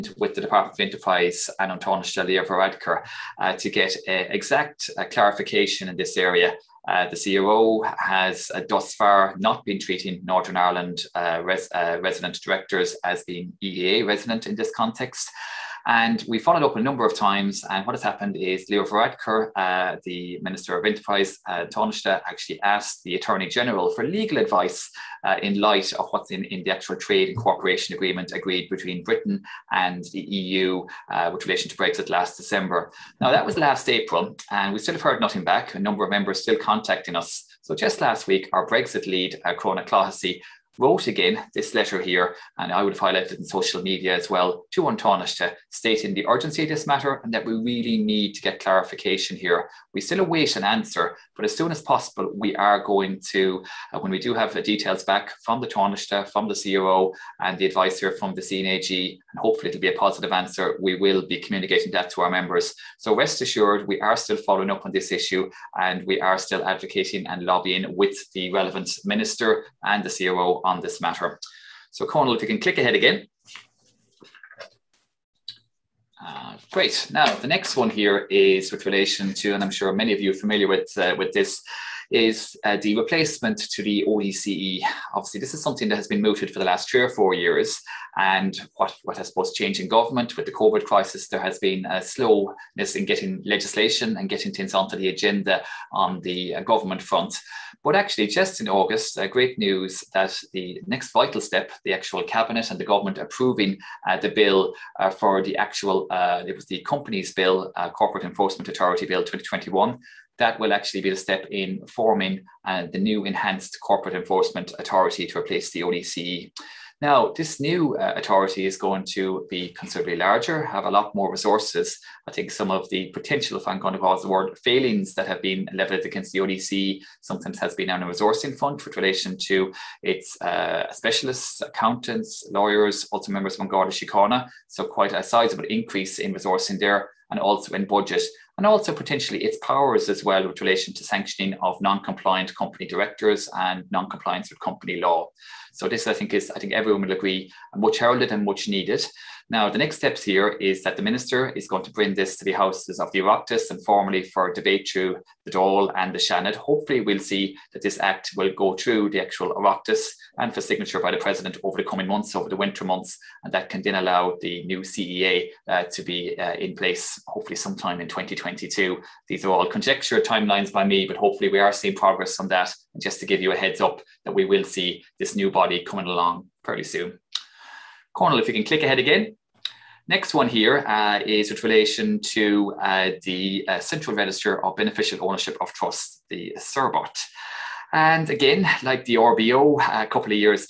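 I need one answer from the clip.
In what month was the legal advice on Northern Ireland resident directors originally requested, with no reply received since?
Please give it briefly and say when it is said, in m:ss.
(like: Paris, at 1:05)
April, at 0:33.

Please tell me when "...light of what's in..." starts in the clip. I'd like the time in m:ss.
0:25.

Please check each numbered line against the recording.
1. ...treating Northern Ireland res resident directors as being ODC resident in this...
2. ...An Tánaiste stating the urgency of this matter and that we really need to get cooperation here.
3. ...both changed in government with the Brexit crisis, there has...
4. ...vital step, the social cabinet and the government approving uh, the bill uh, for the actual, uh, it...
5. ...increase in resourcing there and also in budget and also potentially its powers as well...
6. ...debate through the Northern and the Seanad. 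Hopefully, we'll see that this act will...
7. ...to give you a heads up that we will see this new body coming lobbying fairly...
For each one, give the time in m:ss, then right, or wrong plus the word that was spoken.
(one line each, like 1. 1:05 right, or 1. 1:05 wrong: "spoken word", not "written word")
1. 0:09 wrong: "EEA", not "ODC"
2. 0:44 wrong: "clarification", not "cooperation"
3. 1:29 wrong: "COVID", not "Brexit"
4. 1:41 wrong: "actual", not "social"
5. 2:15 right
6. 2:34 wrong: "Dáil", not "Northern"
7. 2:53 wrong: "along", not "lobbying".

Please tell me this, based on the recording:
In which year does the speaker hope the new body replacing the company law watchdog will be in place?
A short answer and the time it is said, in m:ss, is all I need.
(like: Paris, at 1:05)
2022, at 2:48.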